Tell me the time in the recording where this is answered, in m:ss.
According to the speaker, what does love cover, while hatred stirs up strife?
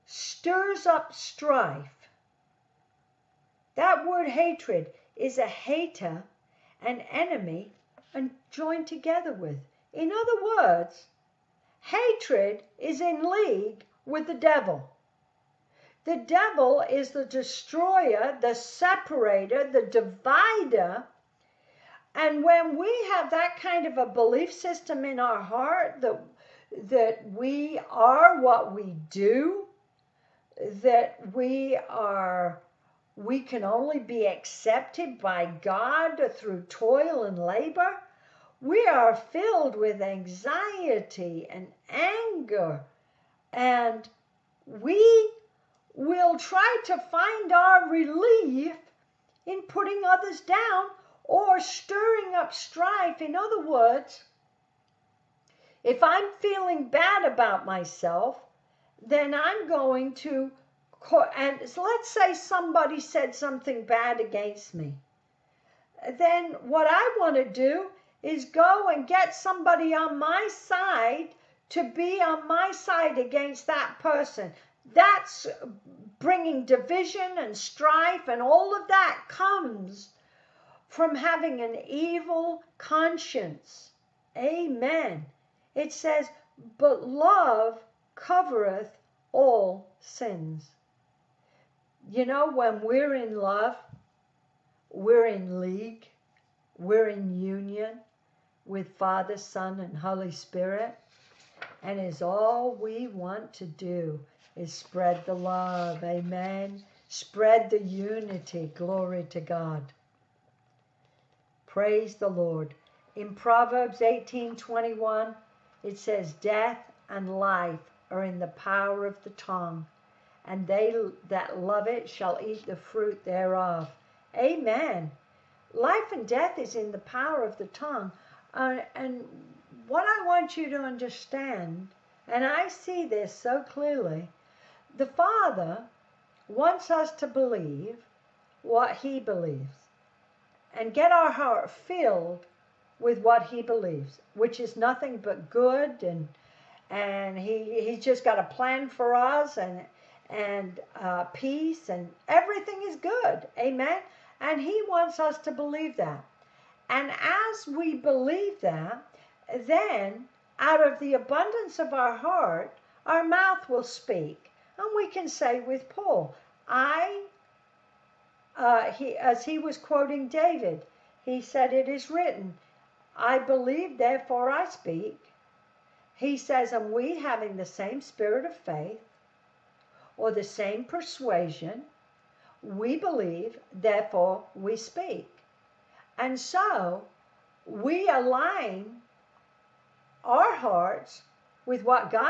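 1:29.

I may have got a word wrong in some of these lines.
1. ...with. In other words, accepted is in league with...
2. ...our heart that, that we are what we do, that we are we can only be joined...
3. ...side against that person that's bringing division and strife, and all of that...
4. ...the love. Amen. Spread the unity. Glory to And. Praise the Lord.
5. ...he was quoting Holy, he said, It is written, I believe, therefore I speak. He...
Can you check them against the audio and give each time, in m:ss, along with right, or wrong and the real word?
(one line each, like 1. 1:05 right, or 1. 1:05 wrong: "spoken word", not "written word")
1. 0:09 wrong: "hatred", not "accepted"
2. 0:25 wrong: "accepted", not "joined"
3. 1:12 right
4. 1:45 wrong: "God", not "And"
5. 2:49 wrong: "David", not "Holy".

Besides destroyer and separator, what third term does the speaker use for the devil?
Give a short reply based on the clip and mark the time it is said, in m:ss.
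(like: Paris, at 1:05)
the divider, at 0:19.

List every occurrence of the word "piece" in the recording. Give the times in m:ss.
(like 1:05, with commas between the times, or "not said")
not said.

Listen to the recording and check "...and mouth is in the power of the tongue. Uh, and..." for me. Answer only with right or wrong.
wrong.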